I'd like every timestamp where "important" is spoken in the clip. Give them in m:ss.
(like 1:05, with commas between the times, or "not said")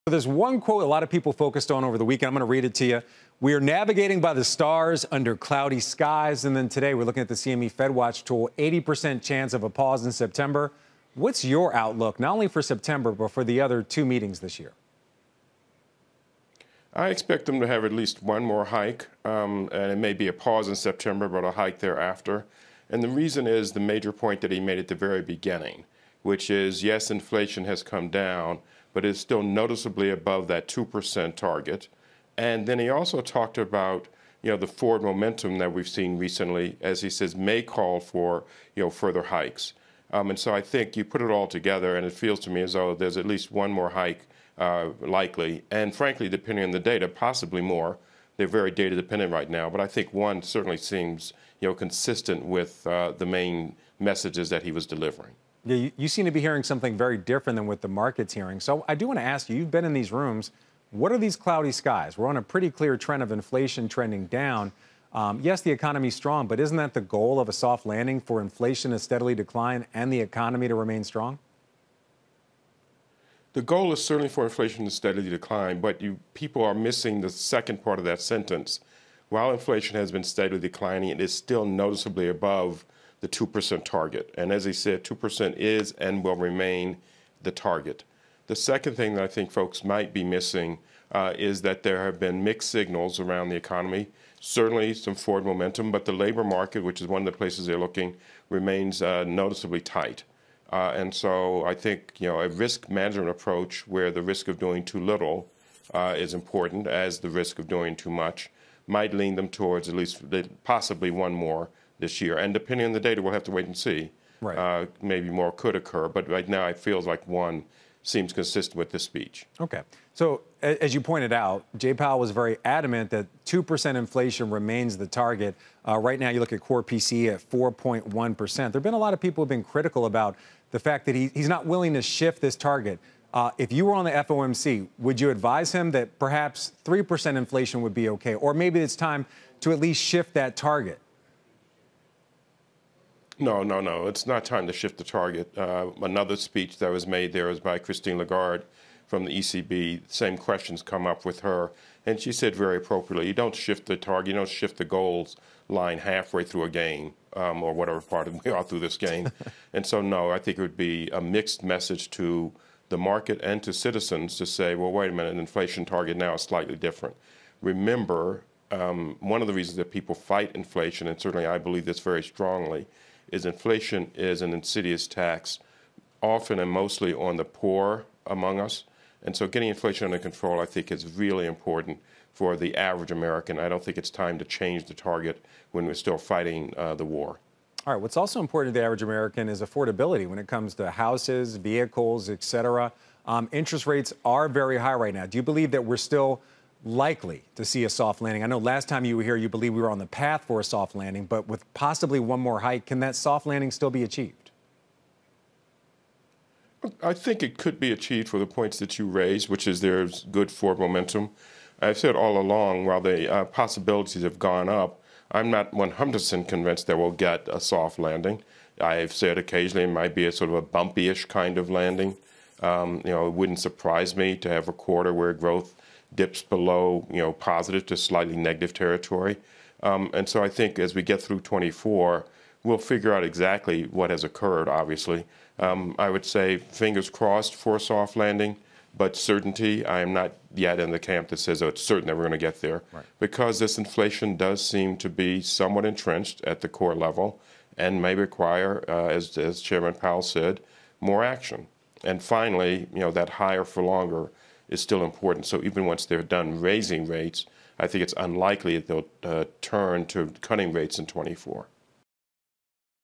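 1:46, 3:01, 3:08, 4:15.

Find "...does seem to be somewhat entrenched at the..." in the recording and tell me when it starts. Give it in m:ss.
4:04.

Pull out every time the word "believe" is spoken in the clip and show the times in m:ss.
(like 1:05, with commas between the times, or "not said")
2:51, 3:15, 3:19.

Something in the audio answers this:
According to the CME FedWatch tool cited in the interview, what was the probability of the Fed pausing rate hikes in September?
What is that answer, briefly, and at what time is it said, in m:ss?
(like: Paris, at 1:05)
80%, at 0:08.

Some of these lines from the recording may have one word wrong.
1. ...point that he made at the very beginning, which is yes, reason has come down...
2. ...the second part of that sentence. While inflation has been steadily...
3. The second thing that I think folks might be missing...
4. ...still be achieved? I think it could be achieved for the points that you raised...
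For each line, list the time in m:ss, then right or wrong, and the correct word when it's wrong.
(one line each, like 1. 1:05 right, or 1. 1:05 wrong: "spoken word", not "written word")
1. 0:24 wrong: "inflation", not "reason"
2. 1:17 right
3. 1:28 right
4. 3:23 right.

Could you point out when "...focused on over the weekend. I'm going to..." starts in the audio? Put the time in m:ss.
0:01.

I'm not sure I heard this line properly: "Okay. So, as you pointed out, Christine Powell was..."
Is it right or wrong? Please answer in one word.
wrong.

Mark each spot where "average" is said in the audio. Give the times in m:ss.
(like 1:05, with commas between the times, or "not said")
3:02, 3:08.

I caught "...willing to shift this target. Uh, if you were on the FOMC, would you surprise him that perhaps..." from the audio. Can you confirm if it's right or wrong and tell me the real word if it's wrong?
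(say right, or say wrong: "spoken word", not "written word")
wrong: "advise", not "surprise".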